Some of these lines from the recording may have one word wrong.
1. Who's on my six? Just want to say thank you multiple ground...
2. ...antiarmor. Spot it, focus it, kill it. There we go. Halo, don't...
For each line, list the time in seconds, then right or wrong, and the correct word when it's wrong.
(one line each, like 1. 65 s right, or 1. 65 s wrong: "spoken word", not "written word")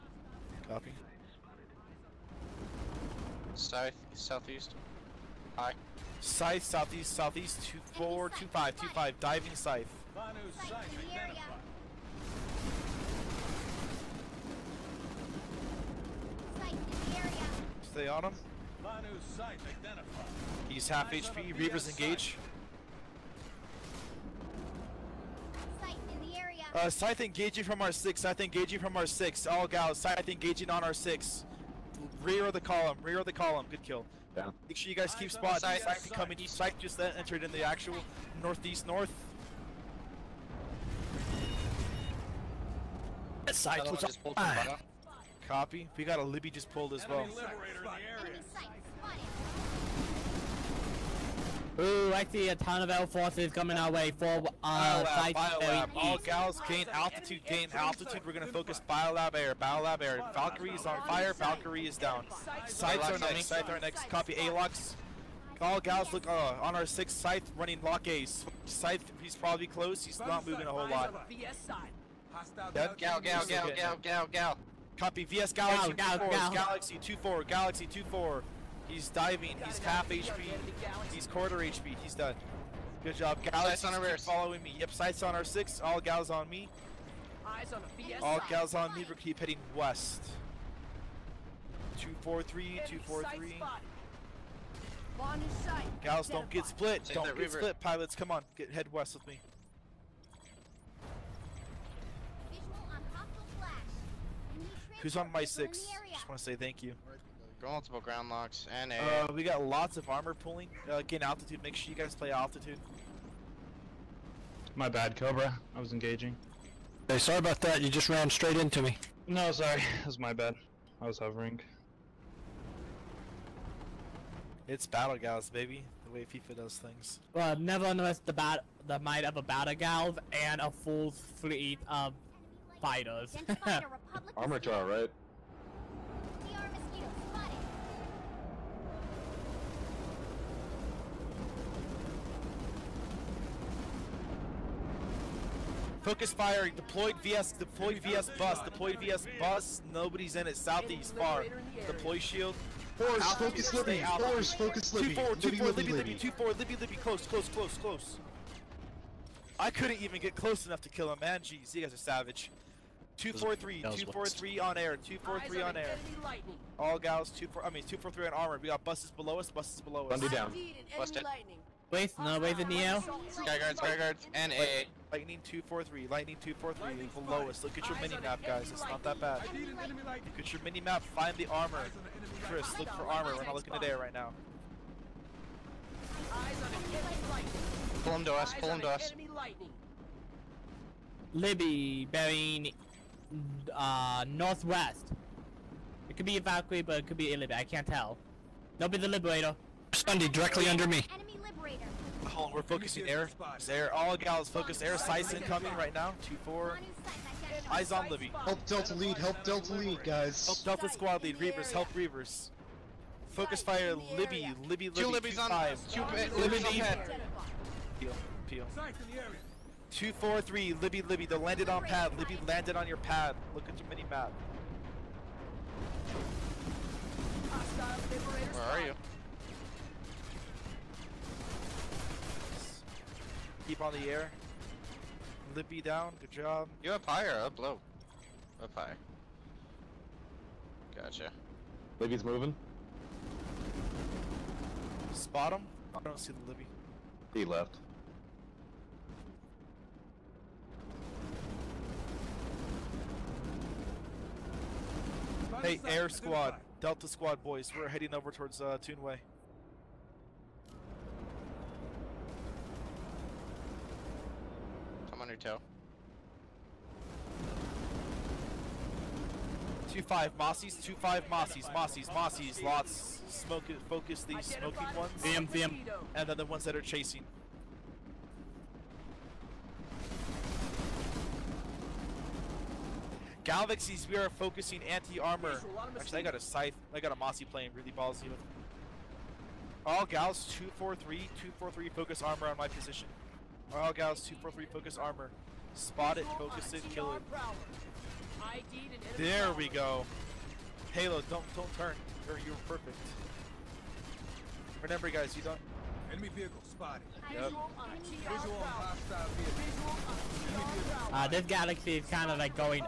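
1. 105 s right
2. 294 s wrong: "armor", not "antiarmor".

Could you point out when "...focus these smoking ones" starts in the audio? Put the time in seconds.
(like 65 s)
273 s.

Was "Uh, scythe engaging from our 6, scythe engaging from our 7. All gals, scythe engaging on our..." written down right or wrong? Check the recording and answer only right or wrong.
wrong.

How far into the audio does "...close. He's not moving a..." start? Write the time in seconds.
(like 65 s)
69 s.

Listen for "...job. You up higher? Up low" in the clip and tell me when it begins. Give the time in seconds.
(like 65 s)
236 s.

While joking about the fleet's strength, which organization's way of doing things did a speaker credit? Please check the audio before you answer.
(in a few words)
FEFA.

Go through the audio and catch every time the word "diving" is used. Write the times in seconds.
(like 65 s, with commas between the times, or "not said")
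9 s, 79 s.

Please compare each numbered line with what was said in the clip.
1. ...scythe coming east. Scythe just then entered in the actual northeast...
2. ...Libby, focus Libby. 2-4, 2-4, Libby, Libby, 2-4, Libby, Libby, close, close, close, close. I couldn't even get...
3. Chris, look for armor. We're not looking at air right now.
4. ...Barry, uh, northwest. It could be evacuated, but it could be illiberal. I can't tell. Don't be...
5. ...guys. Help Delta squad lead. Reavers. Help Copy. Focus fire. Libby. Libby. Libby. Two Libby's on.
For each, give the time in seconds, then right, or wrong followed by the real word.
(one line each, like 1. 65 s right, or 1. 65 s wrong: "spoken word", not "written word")
1. 35 s right
2. 153 s right
3. 182 s right
4. 192 s right
5. 210 s wrong: "Reavers", not "Copy".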